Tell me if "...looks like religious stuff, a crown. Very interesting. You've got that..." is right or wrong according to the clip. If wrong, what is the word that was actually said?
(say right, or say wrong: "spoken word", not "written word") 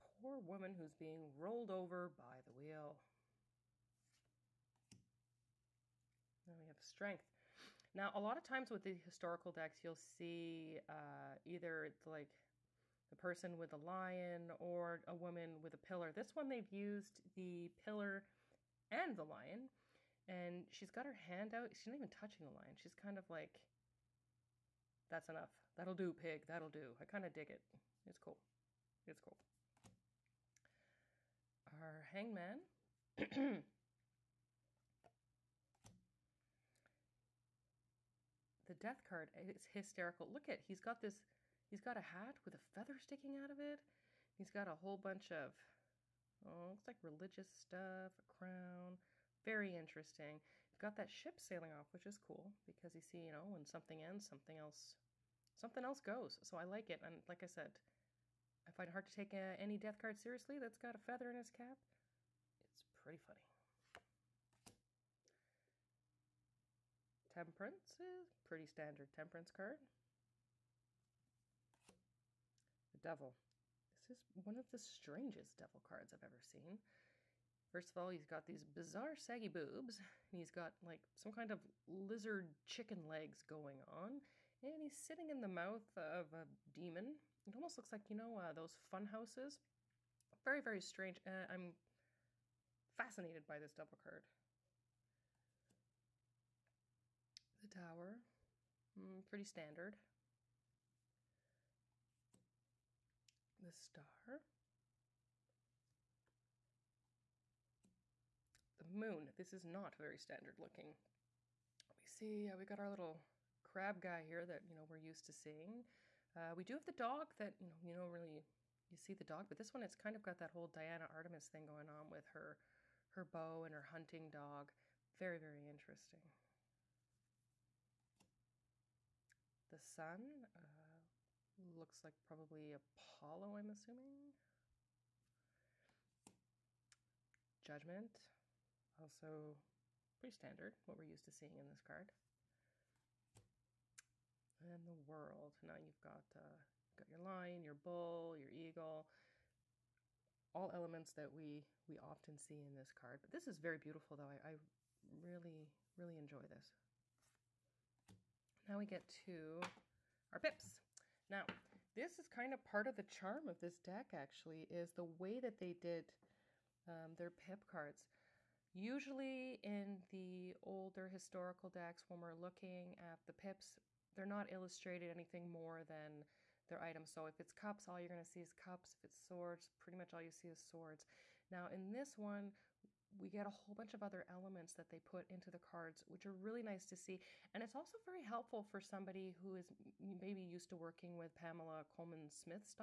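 right.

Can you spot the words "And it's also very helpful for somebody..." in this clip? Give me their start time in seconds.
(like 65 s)
187 s.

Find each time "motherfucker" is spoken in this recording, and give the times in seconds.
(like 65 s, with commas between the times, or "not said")
not said.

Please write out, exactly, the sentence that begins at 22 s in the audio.
She's kind of like, that's enough.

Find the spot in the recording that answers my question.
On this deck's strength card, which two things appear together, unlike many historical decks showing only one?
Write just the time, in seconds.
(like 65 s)
17 s.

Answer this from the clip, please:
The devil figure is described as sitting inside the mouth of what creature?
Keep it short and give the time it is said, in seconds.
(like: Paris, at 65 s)
a demon, at 86 s.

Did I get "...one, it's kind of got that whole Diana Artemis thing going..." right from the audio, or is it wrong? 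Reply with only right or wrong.
right.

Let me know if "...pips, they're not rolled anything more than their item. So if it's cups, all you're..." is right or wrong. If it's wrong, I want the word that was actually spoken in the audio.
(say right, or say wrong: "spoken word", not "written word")
wrong: "illustrated", not "rolled".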